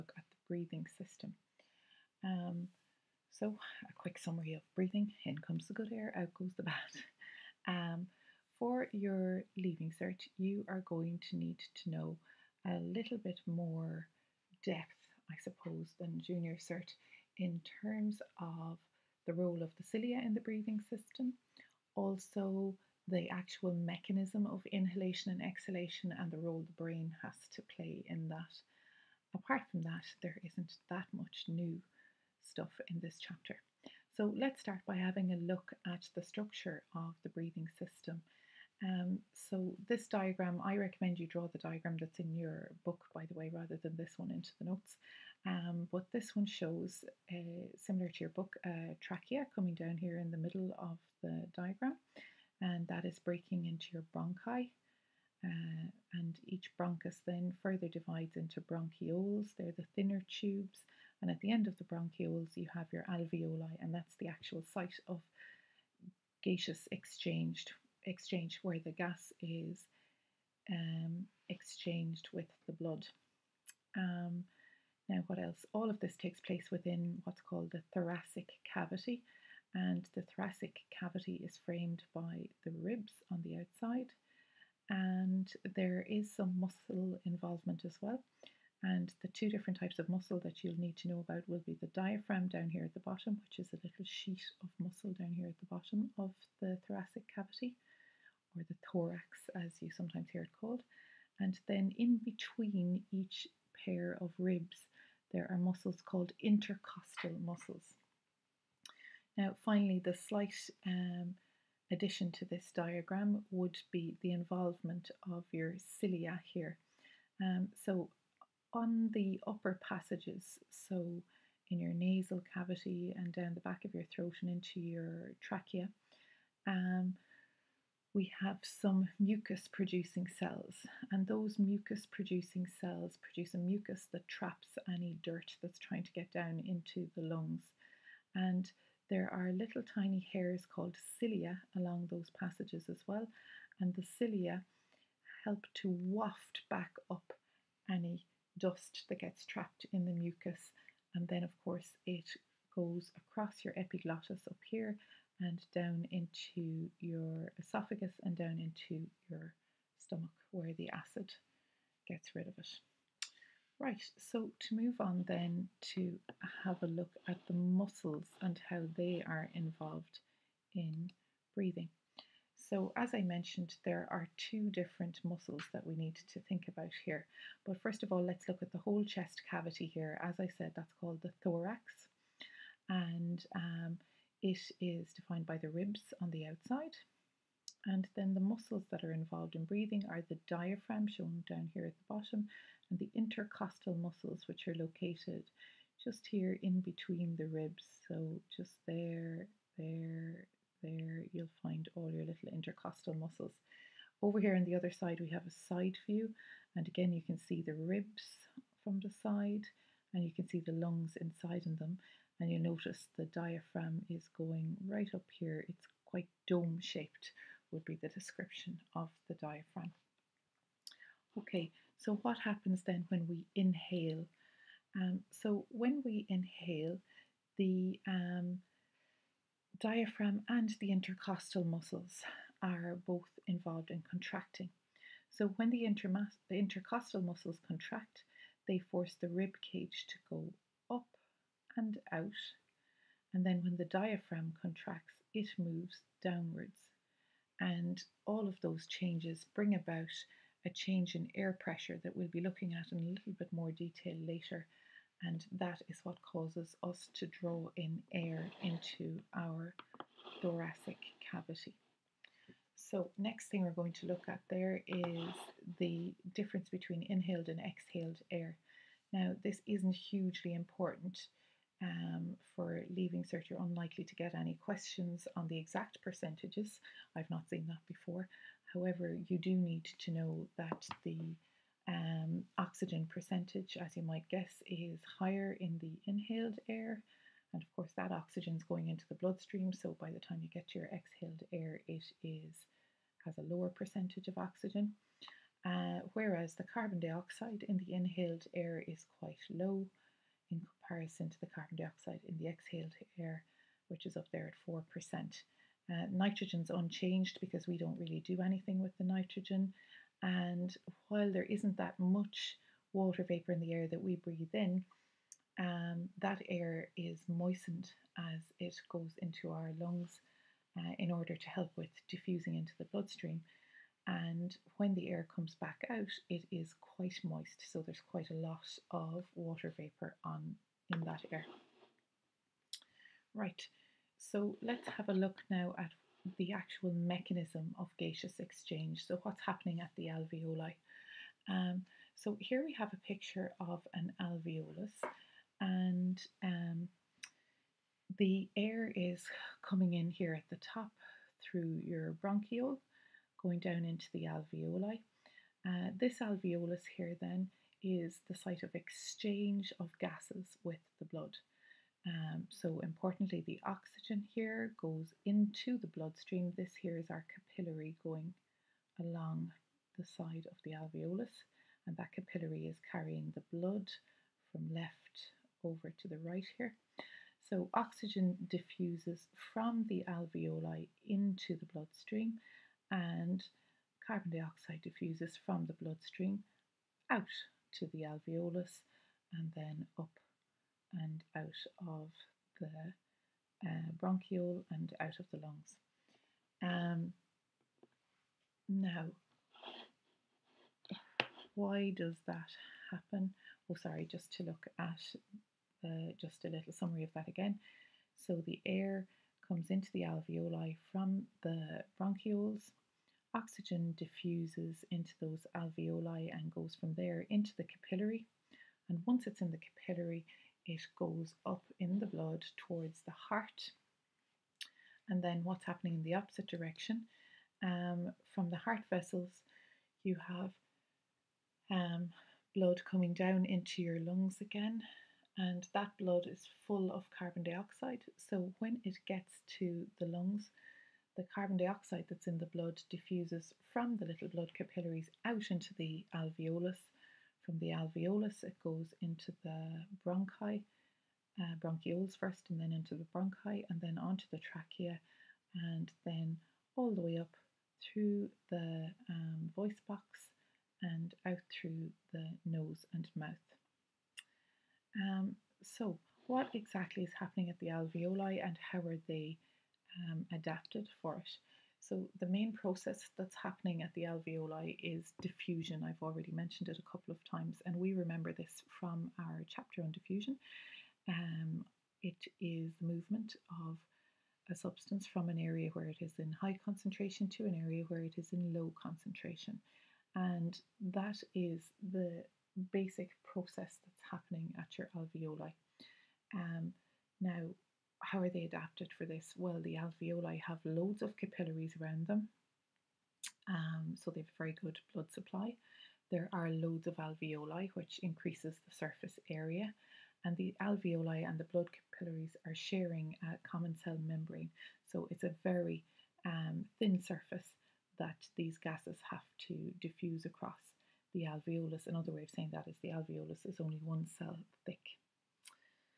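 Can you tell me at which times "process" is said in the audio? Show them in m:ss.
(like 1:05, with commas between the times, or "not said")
7:52, 8:13.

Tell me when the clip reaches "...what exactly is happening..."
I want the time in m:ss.
7:46.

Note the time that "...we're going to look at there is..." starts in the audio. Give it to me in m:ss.
4:23.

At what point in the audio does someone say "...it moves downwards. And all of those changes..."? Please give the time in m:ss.
4:05.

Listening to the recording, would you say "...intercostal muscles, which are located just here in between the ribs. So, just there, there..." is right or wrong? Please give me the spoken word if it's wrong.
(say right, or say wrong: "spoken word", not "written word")
right.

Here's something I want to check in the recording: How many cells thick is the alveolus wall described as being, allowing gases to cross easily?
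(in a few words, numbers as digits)
1.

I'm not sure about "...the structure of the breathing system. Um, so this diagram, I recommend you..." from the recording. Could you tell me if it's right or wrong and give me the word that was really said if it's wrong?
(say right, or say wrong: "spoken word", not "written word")
right.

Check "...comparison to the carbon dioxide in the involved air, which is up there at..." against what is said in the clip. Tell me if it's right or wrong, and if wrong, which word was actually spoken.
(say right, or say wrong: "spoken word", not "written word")
wrong: "exhaled", not "involved".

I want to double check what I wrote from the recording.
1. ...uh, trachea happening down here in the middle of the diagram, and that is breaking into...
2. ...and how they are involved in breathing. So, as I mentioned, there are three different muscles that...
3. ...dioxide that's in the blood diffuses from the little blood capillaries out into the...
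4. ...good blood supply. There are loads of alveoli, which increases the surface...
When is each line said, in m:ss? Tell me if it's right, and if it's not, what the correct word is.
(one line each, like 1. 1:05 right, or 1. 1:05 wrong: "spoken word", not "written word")
1. 0:48 wrong: "coming", not "happening"
2. 2:48 wrong: "two", not "three"
3. 7:21 right
4. 8:24 right.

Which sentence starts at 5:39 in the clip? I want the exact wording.
So what's happening at the alveoli?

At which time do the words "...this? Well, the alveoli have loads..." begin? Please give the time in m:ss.
8:19.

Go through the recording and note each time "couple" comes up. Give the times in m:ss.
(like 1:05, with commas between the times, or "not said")
7:56.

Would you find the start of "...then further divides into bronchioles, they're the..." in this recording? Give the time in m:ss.
0:57.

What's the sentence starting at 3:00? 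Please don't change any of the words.
As I said, that's called the thorax, and um, it is defined by the ribs on the outside.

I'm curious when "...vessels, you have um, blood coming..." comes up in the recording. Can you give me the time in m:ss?
7:08.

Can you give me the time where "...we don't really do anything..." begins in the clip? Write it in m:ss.
5:07.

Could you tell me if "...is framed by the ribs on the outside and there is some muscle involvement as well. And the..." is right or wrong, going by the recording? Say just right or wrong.
right.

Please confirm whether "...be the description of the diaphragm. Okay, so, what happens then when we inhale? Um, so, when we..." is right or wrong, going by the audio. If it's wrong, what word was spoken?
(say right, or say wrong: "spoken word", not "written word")
right.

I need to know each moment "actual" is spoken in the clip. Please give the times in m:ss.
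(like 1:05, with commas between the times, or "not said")
0:23, 1:04, 5:36.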